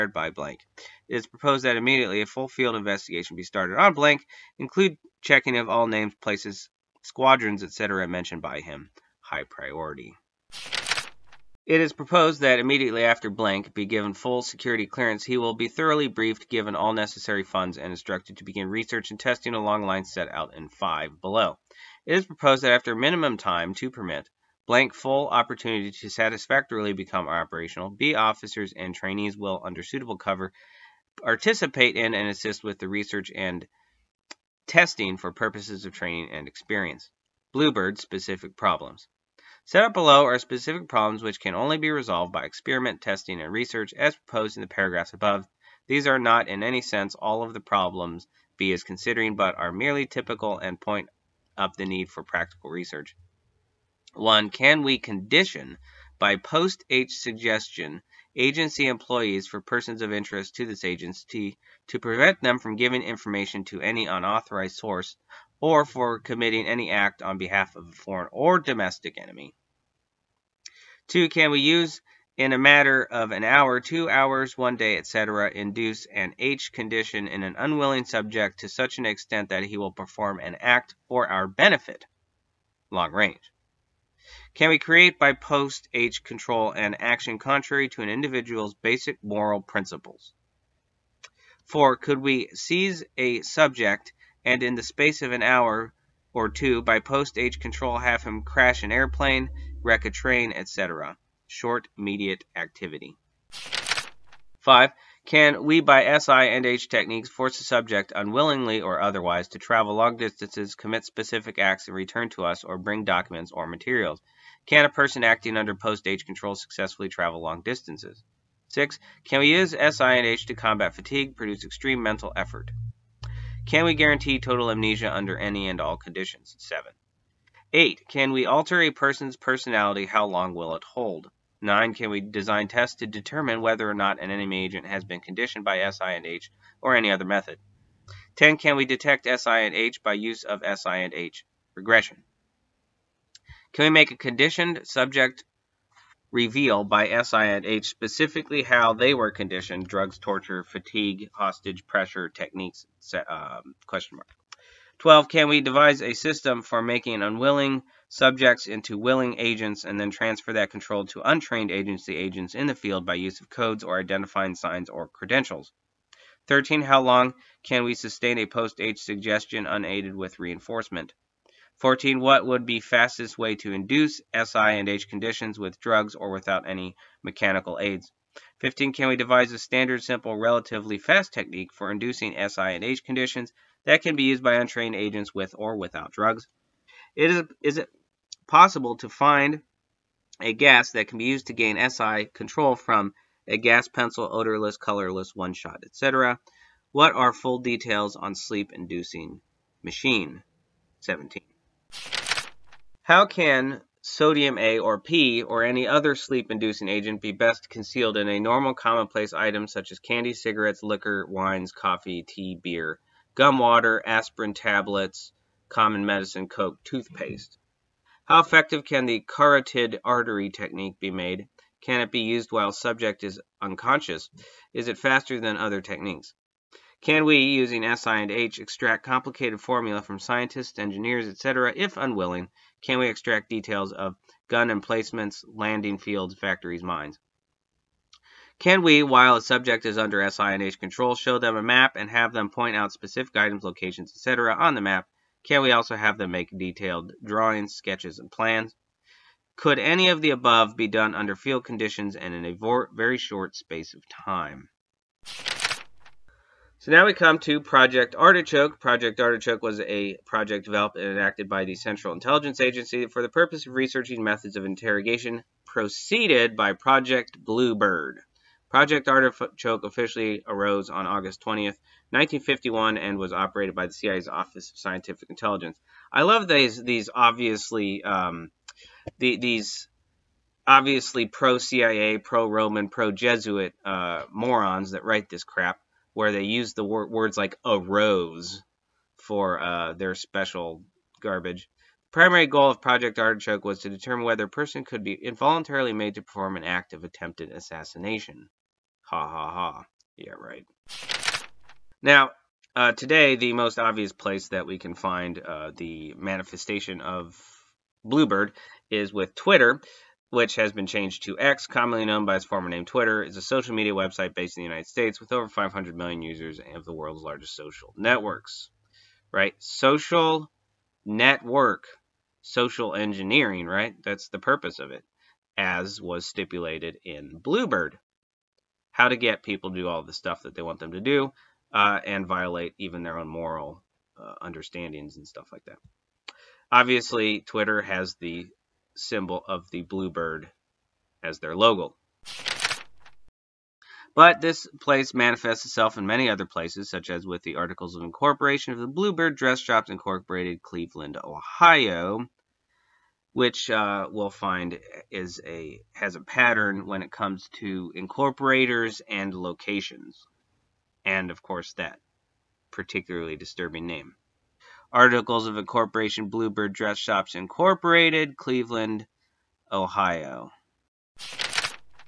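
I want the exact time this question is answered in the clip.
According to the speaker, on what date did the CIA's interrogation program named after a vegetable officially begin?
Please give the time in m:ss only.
4:31.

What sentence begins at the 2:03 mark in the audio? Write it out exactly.
Can we guarantee total amnesia under any and all conditions?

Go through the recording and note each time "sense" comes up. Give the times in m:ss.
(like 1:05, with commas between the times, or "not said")
0:46.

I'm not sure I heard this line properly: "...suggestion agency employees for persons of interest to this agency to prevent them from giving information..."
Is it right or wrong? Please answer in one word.
right.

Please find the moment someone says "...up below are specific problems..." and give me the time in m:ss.
0:39.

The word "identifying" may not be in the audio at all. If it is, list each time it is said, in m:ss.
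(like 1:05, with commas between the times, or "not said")
2:43.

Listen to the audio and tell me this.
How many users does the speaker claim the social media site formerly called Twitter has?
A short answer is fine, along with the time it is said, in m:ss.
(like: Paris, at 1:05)
over 500 million, at 5:15.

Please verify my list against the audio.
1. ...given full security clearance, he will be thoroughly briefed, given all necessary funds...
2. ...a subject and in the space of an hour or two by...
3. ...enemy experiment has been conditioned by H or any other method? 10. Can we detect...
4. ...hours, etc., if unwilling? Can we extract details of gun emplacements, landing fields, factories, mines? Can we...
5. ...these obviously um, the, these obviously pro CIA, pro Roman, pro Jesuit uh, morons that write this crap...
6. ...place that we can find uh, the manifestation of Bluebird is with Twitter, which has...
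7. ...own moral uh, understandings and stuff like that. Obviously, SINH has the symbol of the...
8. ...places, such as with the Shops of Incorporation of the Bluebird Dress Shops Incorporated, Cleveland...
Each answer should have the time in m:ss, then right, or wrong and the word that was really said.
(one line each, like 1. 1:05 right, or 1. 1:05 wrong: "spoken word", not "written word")
1. 0:13 right
2. 1:33 right
3. 2:14 wrong: "agent", not "experiment"
4. 3:50 wrong: "engineers", not "hours"
5. 4:36 right
6. 5:04 right
7. 5:33 wrong: "Twitter", not "SINH"
8. 5:46 wrong: "Articles", not "Shops".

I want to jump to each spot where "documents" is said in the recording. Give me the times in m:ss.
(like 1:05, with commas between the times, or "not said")
1:53.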